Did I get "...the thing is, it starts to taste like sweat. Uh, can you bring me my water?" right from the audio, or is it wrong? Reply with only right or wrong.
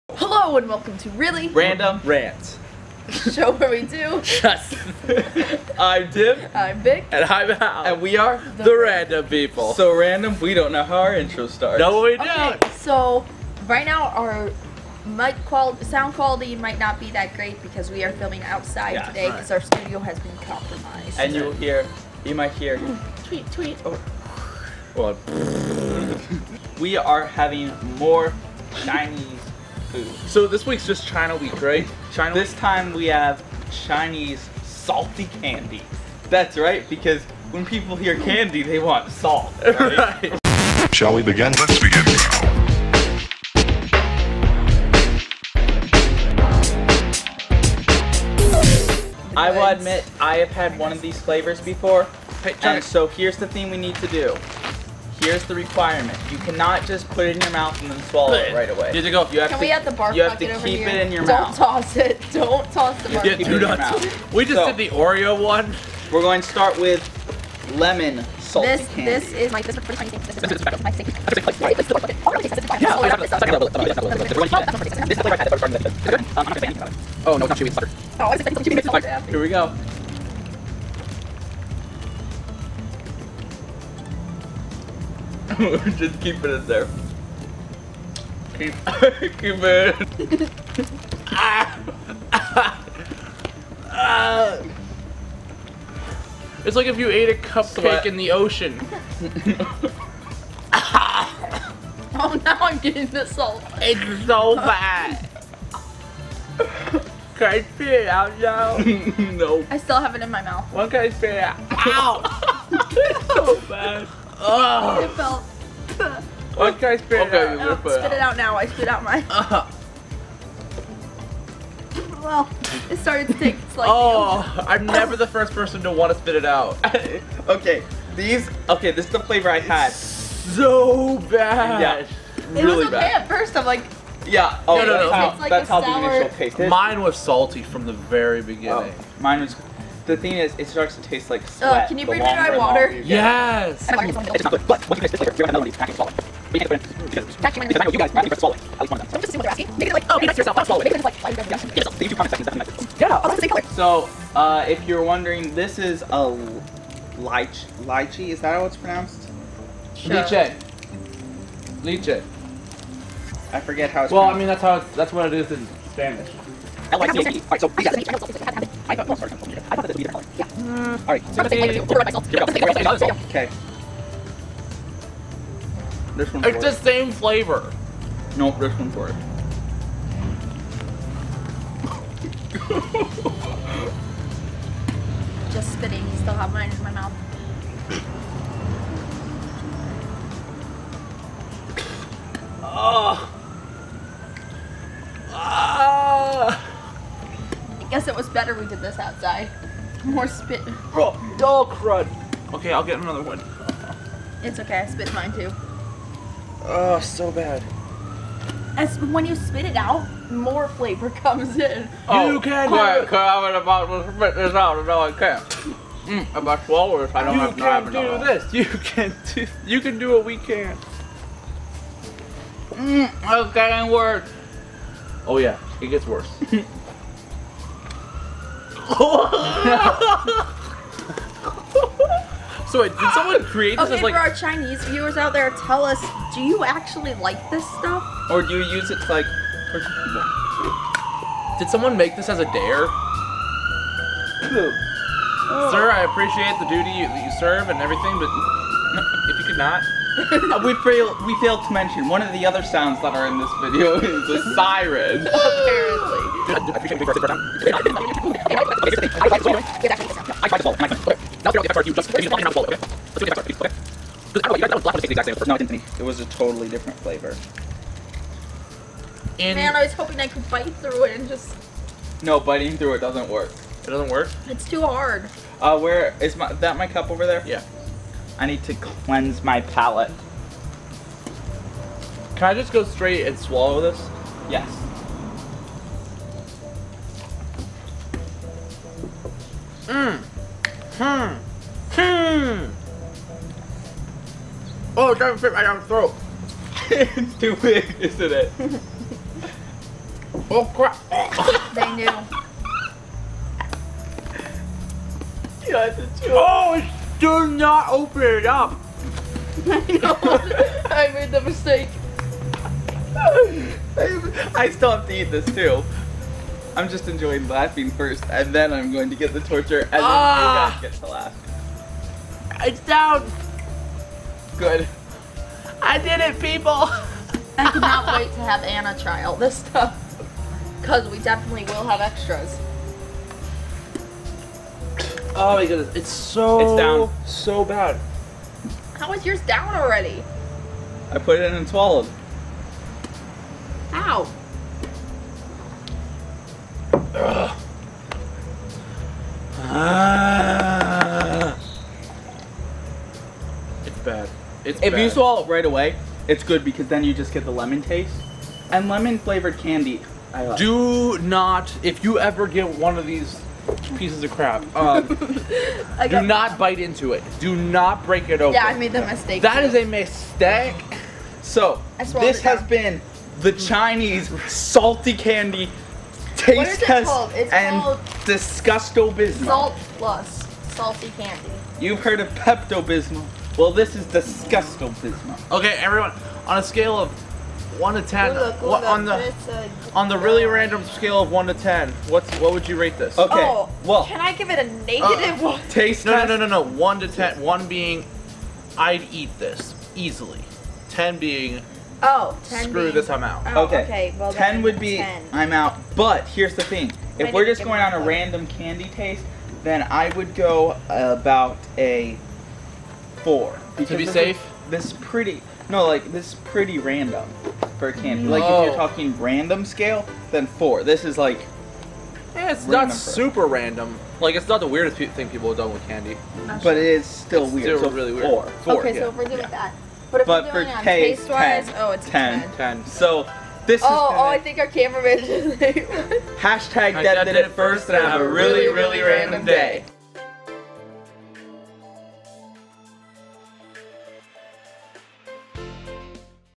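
right.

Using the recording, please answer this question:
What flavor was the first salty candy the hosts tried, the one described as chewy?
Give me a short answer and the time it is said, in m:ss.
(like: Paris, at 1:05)
Lemon salt, at 1:07.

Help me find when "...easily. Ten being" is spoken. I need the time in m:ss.
6:39.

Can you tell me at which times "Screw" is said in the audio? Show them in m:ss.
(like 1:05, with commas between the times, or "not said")
6:42.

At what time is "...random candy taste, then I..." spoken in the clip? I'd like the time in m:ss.
6:47.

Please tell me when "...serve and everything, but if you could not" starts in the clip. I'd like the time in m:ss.
4:07.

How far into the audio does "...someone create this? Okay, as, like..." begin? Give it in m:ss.
3:53.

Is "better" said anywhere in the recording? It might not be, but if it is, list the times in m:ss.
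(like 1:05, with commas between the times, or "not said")
3:18.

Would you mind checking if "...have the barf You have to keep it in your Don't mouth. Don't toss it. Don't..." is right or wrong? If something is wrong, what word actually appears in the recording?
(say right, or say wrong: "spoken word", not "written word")
right.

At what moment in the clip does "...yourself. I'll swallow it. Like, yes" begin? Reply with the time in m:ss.
2:30.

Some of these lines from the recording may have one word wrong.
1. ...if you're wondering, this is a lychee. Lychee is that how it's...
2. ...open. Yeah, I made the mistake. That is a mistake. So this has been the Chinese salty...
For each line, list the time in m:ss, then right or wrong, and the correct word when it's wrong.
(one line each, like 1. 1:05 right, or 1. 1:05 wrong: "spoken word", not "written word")
1. 2:34 right
2. 6:08 right.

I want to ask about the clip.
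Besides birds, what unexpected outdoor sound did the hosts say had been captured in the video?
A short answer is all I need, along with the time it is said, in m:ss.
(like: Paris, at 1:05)
A siren, at 4:14.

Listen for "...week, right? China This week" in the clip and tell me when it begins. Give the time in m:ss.
0:31.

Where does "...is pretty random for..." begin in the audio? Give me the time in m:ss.
6:56.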